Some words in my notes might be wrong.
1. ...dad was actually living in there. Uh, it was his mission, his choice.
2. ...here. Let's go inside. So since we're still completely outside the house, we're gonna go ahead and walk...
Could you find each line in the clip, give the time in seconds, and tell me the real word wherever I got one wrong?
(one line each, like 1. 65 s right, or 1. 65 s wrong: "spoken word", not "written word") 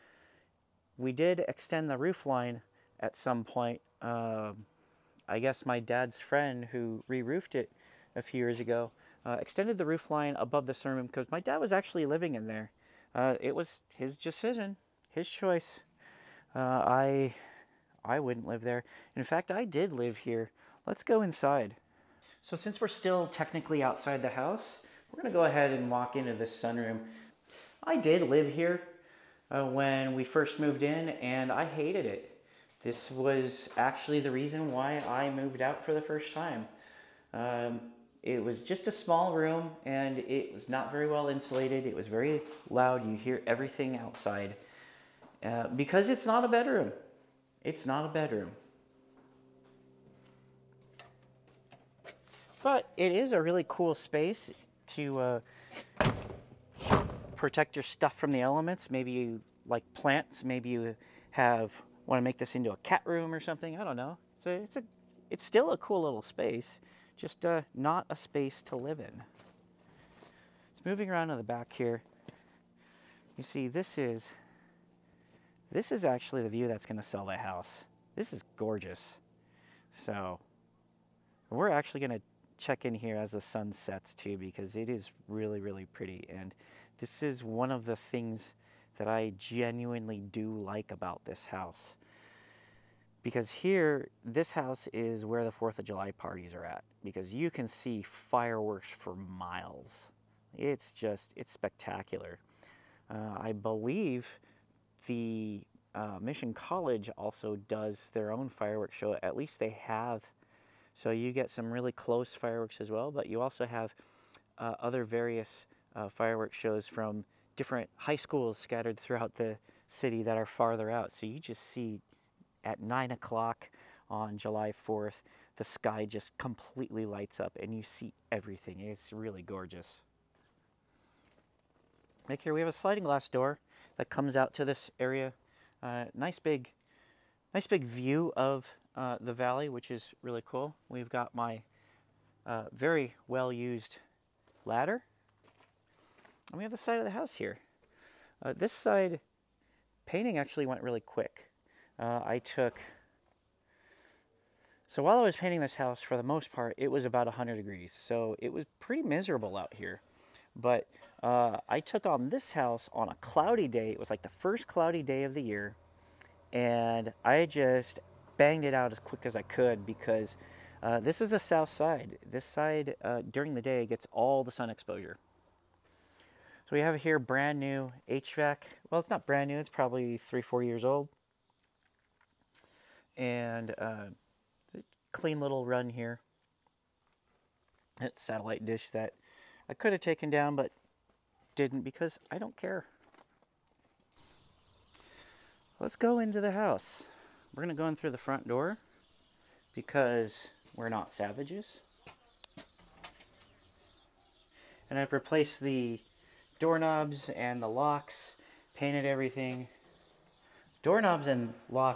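1. 11 s wrong: "decision", not "mission"
2. 20 s wrong: "technically", not "completely".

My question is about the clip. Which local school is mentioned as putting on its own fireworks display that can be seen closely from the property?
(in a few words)
Mission College.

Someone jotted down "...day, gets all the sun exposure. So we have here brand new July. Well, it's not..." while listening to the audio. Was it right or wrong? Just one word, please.
wrong.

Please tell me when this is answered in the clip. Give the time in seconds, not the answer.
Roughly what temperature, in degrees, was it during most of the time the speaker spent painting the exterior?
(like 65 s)
157 s.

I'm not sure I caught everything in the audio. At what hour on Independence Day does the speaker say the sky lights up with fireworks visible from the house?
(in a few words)
9 o'clock.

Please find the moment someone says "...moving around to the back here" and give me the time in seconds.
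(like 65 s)
70 s.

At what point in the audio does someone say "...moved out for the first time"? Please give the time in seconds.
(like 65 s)
35 s.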